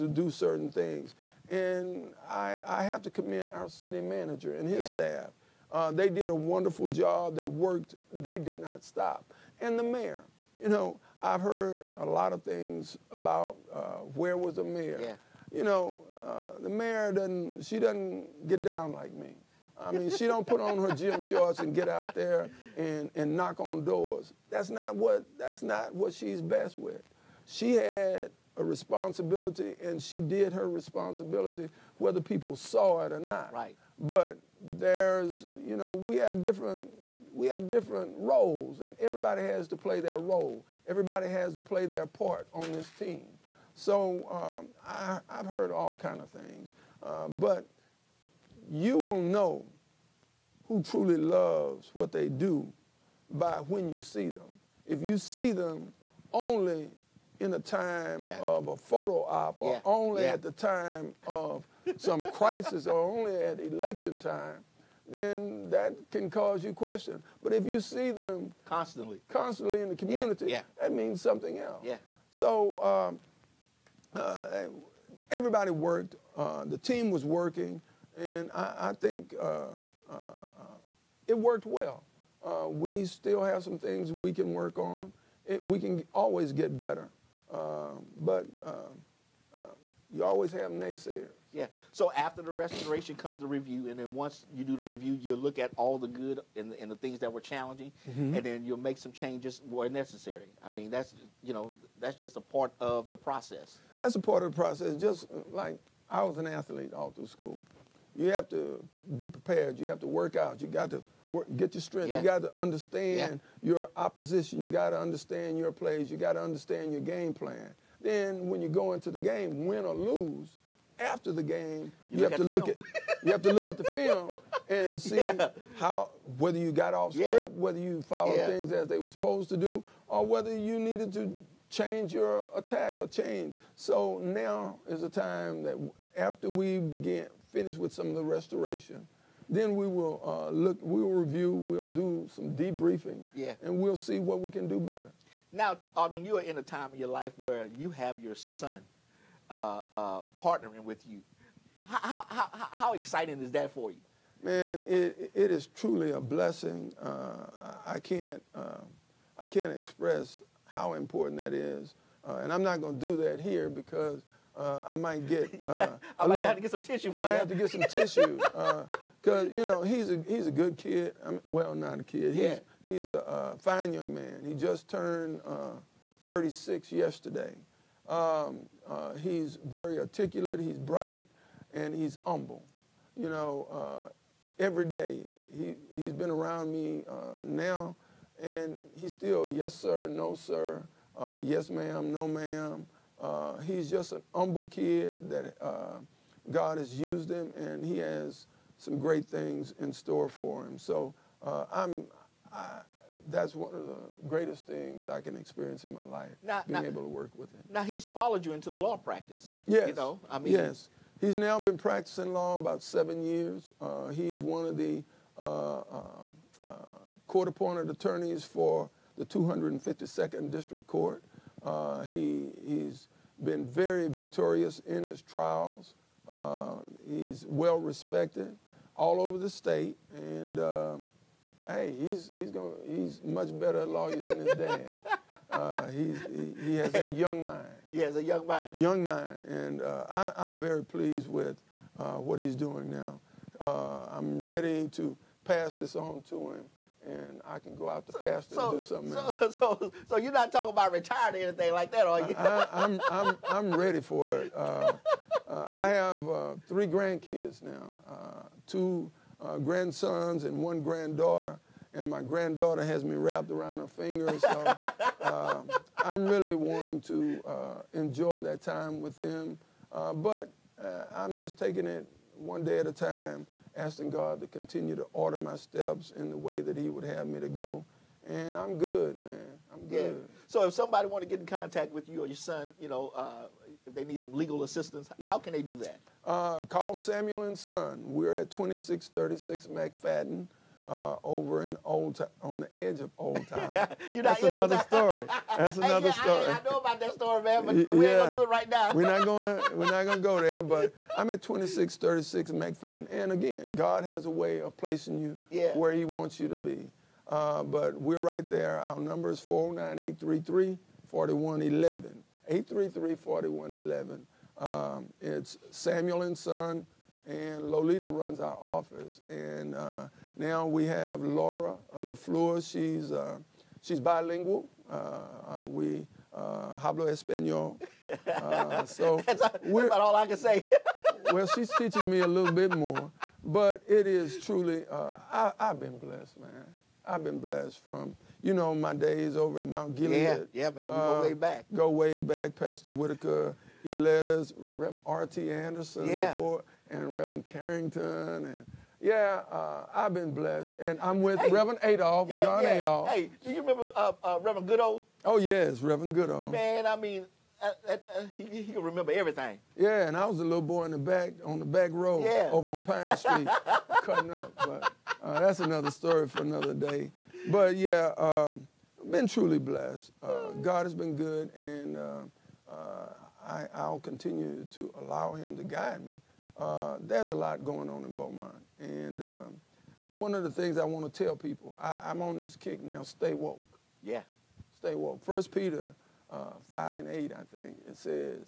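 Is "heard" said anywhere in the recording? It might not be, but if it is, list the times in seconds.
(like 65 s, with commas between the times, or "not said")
11 s, 45 s.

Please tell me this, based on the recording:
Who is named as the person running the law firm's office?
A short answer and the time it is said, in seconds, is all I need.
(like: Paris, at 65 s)
Lolita, at 317 s.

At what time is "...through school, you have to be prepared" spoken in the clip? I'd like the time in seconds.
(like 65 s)
107 s.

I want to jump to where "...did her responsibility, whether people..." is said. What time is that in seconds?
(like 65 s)
30 s.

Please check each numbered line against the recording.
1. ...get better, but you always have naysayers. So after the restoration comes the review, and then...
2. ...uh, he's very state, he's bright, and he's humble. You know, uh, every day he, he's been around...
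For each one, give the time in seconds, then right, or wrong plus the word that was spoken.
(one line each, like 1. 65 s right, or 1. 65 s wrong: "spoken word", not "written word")
1. 86 s right
2. 178 s wrong: "articulate", not "state".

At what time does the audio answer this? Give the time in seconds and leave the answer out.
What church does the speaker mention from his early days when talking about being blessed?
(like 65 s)
339 s.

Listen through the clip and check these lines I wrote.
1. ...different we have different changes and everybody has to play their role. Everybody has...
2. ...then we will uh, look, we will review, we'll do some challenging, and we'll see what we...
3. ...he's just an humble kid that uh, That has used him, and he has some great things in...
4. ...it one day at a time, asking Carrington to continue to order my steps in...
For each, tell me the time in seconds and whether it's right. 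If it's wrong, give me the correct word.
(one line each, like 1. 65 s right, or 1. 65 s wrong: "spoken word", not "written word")
1. 36 s wrong: "roles", not "changes"
2. 139 s wrong: "debriefing", not "challenging"
3. 193 s wrong: "God", not "That"
4. 271 s wrong: "God", not "Carrington".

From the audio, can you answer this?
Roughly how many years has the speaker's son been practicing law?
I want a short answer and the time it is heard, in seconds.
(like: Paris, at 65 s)
7, at 212 s.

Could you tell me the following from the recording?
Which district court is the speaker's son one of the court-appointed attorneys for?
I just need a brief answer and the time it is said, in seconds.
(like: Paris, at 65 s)
252nd District Court, at 219 s.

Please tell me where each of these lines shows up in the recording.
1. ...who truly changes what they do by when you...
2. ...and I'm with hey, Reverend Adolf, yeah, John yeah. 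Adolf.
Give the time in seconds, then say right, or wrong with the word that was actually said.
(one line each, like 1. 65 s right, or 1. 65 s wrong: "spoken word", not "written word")
1. 50 s wrong: "loves", not "changes"
2. 350 s right.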